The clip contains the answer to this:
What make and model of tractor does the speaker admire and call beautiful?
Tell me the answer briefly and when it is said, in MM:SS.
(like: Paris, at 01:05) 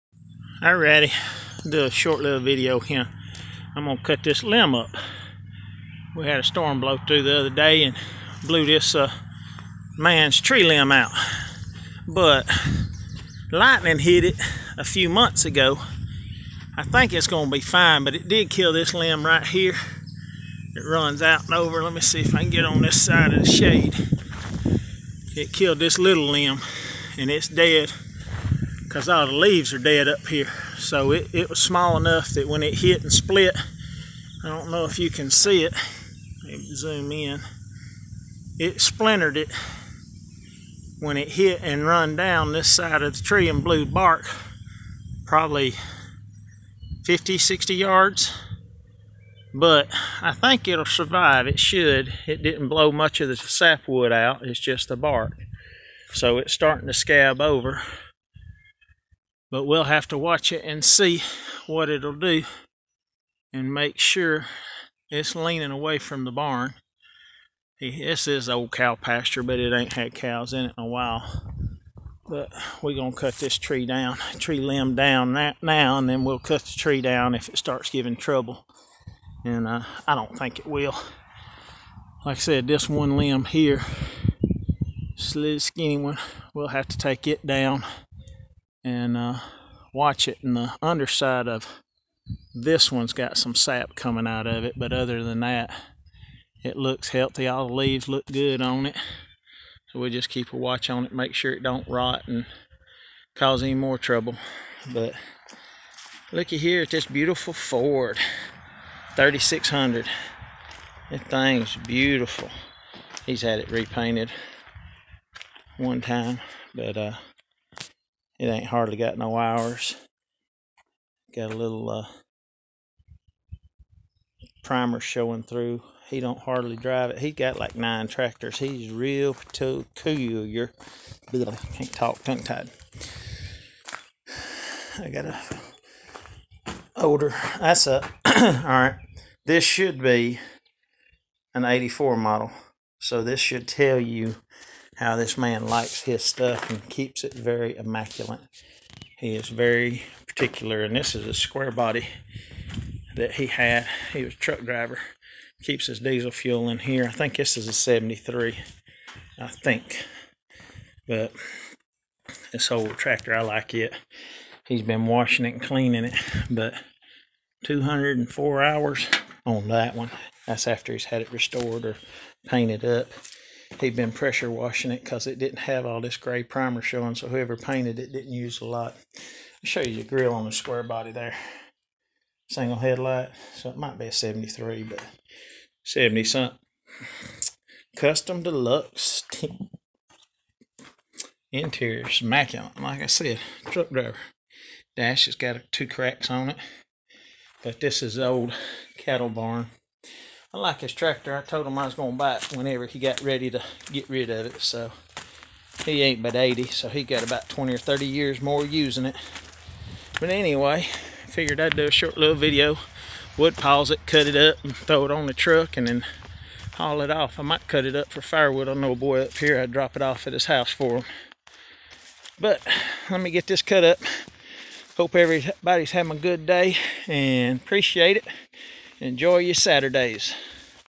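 Ford 3600, at 01:47.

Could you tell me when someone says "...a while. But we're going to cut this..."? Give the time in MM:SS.
01:10.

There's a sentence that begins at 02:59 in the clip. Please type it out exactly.
I'll show you the grill on the square body there.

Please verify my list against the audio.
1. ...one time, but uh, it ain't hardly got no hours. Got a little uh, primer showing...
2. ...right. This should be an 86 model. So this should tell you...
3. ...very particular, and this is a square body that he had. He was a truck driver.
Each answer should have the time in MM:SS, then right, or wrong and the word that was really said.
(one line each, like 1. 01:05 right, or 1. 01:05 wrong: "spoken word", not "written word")
1. 01:55 right
2. 02:18 wrong: "84", not "86"
3. 02:29 right.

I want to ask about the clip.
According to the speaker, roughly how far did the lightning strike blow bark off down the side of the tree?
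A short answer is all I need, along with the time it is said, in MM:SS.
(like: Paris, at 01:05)
50 to 60 yards, at 00:47.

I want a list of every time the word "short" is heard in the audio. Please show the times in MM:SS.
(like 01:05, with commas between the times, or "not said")
00:01, 03:31.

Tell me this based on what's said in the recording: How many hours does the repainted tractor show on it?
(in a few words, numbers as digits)
204.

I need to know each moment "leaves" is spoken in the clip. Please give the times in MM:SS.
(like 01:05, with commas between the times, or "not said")
00:29, 01:37.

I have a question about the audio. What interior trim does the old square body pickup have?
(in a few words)
Custom Deluxe.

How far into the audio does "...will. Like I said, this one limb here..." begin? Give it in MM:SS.
01:20.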